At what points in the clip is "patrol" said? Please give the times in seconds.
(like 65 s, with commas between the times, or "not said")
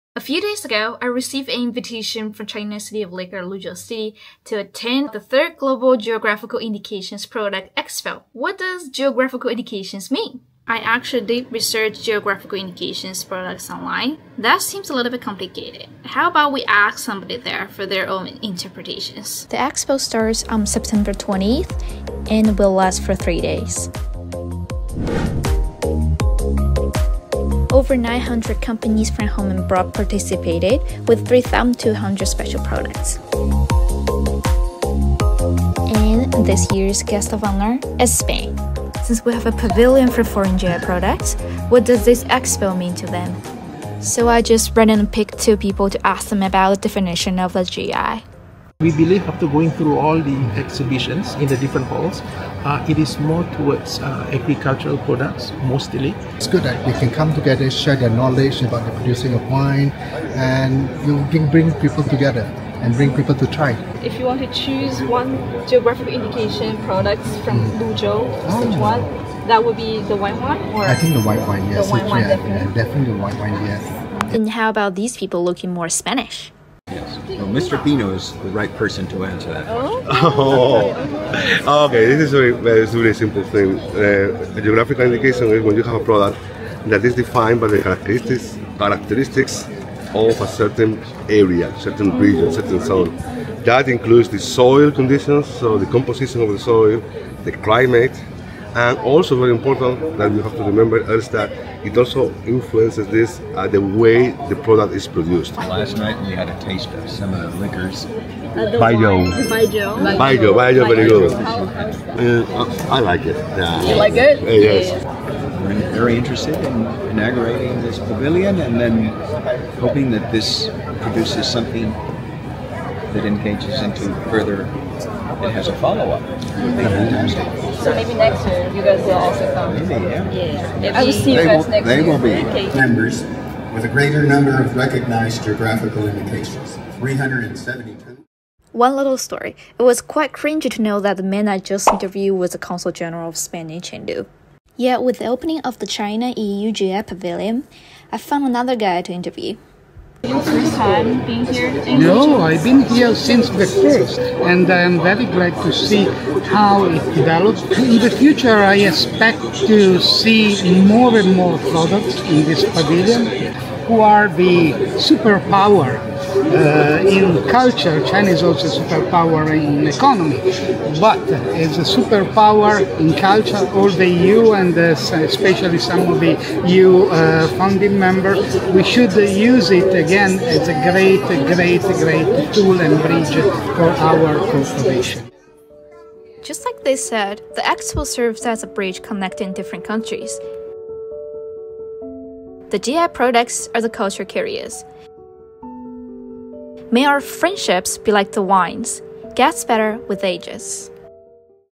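not said.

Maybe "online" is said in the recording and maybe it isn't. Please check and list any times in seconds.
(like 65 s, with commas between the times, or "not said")
13 s.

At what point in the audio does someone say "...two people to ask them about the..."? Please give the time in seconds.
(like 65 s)
45 s.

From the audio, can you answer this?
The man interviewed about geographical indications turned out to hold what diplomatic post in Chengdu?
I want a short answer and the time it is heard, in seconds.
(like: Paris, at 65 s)
Consul General of Spain, at 142 s.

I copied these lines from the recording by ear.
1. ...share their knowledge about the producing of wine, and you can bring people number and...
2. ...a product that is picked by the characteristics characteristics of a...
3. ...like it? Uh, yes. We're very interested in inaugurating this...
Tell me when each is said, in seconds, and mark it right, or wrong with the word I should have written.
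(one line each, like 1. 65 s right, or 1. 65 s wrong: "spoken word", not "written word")
1. 57 s wrong: "together", not "number"
2. 85 s wrong: "defined", not "picked"
3. 113 s right.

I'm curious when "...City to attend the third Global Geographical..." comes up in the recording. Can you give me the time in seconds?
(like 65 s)
3 s.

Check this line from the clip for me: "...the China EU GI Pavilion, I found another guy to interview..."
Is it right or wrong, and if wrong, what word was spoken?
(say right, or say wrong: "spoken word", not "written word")
right.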